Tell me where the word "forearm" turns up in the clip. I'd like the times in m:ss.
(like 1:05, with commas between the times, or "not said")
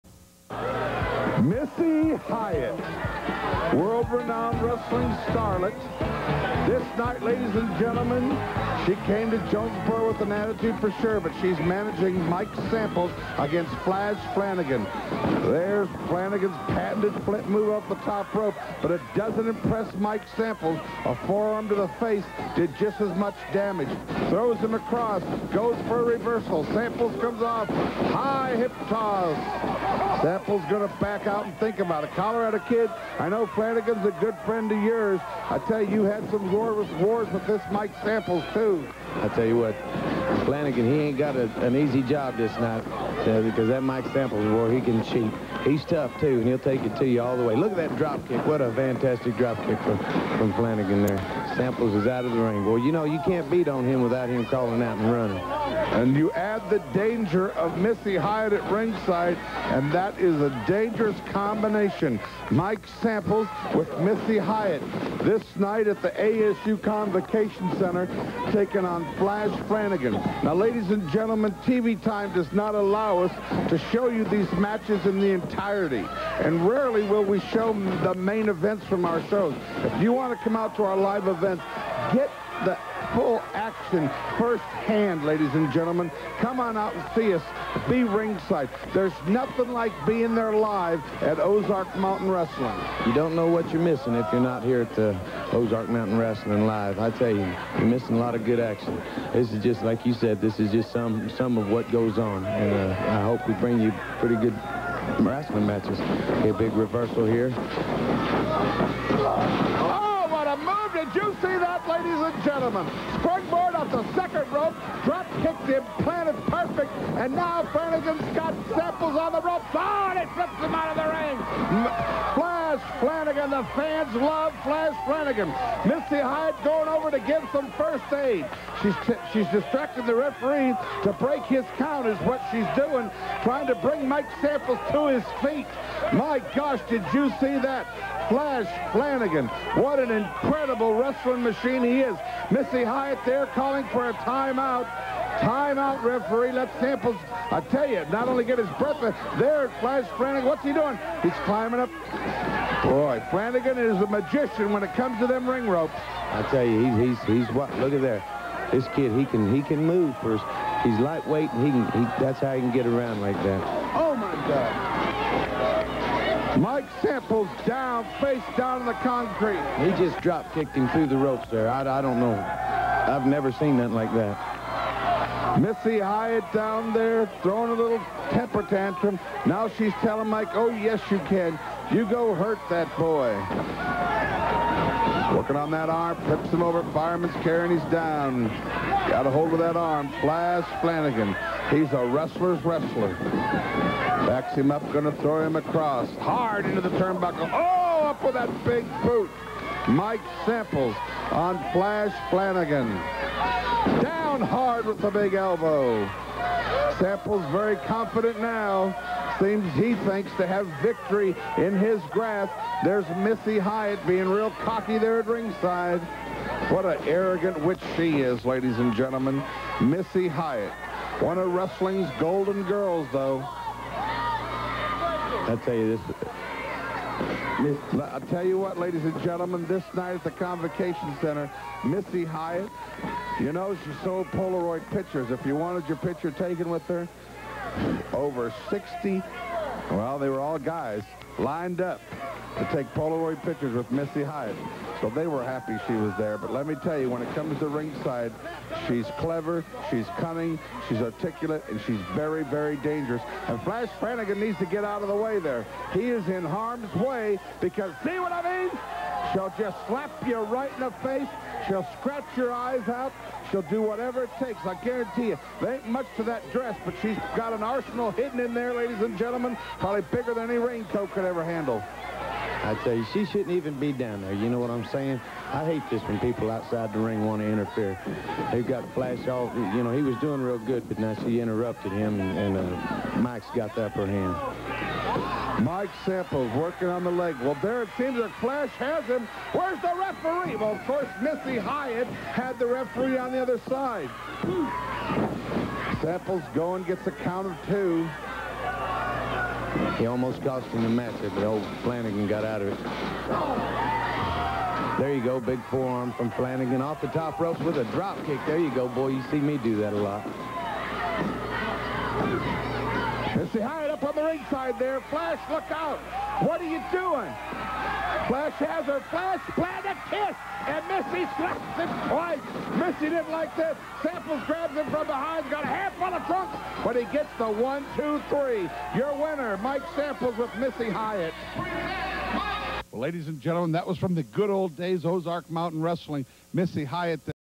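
0:21, 5:05.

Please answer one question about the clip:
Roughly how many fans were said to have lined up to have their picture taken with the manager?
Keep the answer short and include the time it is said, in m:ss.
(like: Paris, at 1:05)
over 60, at 3:58.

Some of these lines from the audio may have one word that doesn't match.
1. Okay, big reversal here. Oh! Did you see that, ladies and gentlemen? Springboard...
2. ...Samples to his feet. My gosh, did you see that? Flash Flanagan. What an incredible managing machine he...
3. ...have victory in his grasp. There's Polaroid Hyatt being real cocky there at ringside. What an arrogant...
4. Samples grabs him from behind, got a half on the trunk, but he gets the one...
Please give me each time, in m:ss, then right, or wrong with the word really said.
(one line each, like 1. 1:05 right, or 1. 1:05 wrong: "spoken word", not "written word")
1. 1:46 right
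2. 2:14 wrong: "wrestling", not "managing"
3. 3:30 wrong: "Missy", not "Polaroid"
4. 5:24 right.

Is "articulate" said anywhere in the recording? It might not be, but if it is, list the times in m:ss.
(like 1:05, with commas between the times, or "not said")
4:10.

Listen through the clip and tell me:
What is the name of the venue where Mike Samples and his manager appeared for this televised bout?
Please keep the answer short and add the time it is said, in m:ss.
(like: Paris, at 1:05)
ASU Convocation Center, at 1:06.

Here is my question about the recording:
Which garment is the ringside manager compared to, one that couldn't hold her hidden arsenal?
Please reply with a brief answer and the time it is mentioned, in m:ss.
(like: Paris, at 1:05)
raincoat, at 4:30.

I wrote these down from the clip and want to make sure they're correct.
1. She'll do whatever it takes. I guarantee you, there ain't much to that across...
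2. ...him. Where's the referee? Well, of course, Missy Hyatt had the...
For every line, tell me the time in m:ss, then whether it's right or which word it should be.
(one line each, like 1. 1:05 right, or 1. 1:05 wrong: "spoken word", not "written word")
1. 4:23 wrong: "dress", not "across"
2. 4:49 right.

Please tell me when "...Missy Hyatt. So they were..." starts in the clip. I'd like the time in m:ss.
4:03.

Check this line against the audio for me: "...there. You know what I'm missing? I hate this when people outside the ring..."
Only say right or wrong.
wrong.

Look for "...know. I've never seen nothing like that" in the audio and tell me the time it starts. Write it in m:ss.
2:52.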